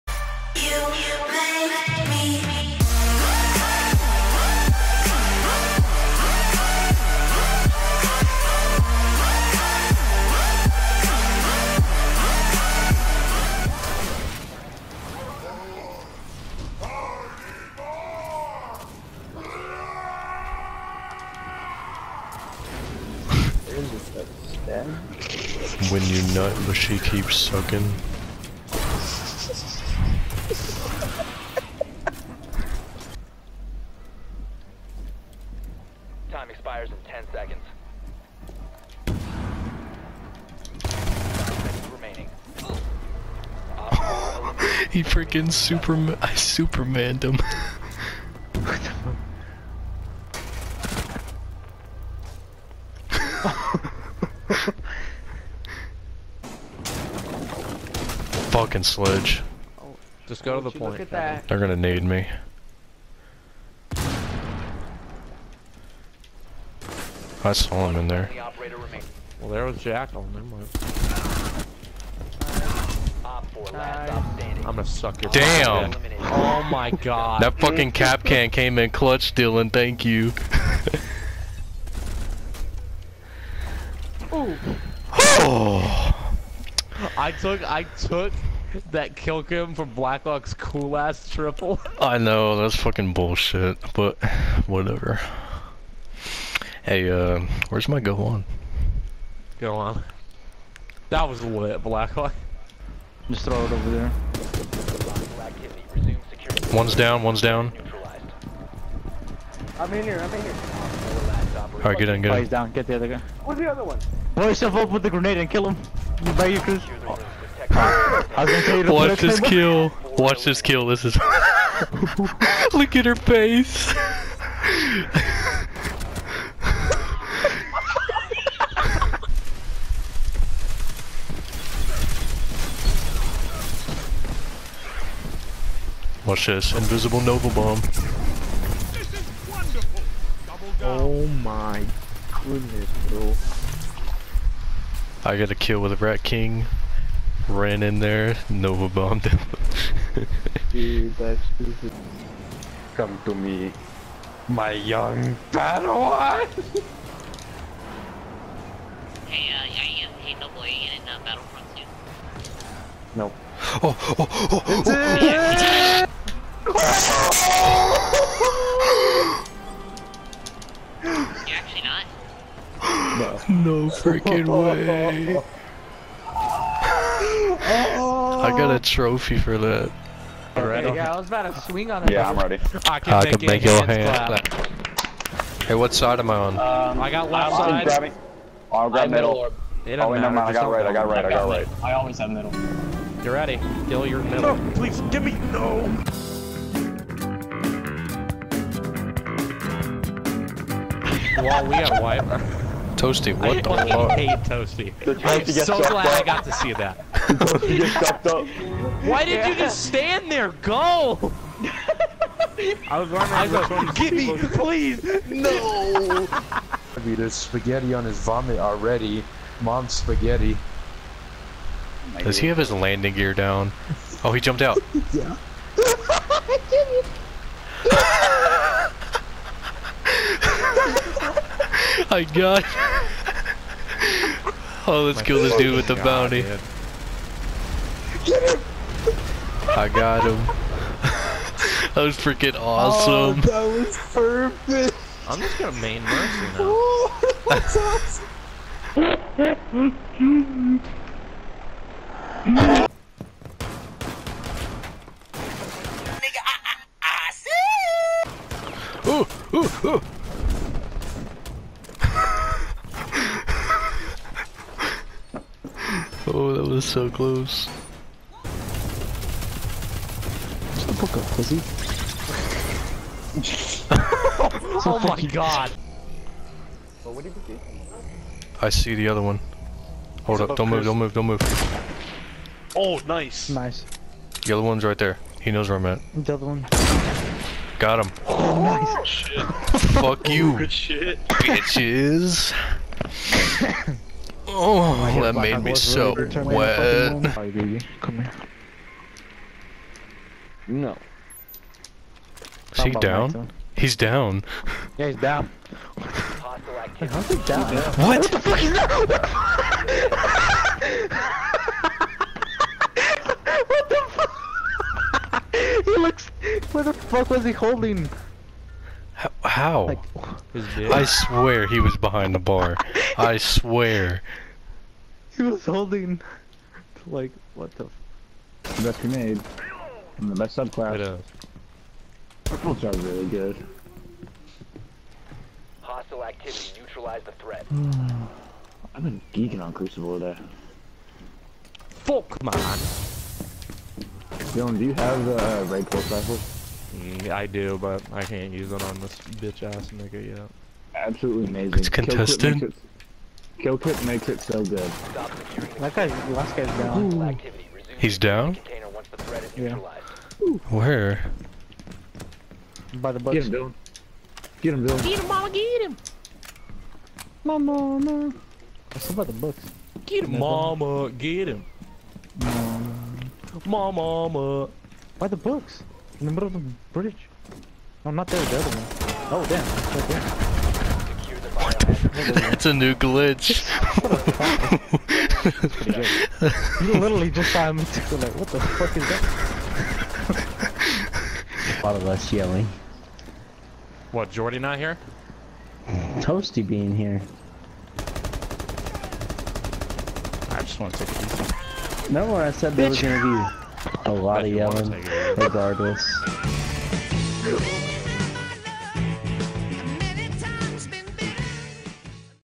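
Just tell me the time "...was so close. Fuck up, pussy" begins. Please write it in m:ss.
4:26.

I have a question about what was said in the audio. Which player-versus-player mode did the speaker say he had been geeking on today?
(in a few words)
Crucible.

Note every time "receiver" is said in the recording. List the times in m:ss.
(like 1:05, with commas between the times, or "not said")
not said.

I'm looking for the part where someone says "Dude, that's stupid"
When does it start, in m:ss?
2:30.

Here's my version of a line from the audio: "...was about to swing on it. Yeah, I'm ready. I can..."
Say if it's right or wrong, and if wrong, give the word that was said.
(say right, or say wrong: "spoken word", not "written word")
right.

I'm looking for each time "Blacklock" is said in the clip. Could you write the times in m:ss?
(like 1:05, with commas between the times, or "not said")
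1:29, 1:41.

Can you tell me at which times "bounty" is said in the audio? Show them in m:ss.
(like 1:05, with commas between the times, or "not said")
3:55.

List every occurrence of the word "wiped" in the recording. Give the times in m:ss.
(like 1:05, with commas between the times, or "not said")
3:22.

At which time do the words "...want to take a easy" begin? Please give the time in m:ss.
6:40.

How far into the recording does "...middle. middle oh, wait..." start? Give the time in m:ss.
3:09.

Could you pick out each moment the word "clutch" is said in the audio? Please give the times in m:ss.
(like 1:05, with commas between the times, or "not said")
1:18.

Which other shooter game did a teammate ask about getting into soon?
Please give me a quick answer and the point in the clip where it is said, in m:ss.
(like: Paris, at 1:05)
Battlefront, at 2:41.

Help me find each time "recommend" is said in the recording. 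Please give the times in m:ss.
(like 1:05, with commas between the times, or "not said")
not said.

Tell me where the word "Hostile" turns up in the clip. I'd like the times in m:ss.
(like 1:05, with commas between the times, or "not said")
5:35.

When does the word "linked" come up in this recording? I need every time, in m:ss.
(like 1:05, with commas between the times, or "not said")
not said.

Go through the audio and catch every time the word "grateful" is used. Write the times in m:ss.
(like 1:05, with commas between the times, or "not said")
not said.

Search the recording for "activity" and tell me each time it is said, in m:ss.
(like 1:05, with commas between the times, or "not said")
5:36.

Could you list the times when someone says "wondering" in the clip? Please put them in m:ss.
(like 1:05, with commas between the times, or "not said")
3:33.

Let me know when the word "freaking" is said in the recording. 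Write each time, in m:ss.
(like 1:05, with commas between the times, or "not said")
0:45, 2:53, 4:02.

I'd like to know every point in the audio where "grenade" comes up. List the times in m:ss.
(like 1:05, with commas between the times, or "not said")
1:55, 5:29.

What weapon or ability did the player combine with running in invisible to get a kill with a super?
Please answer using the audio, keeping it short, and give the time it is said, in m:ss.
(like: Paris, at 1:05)
Rat King, at 2:25.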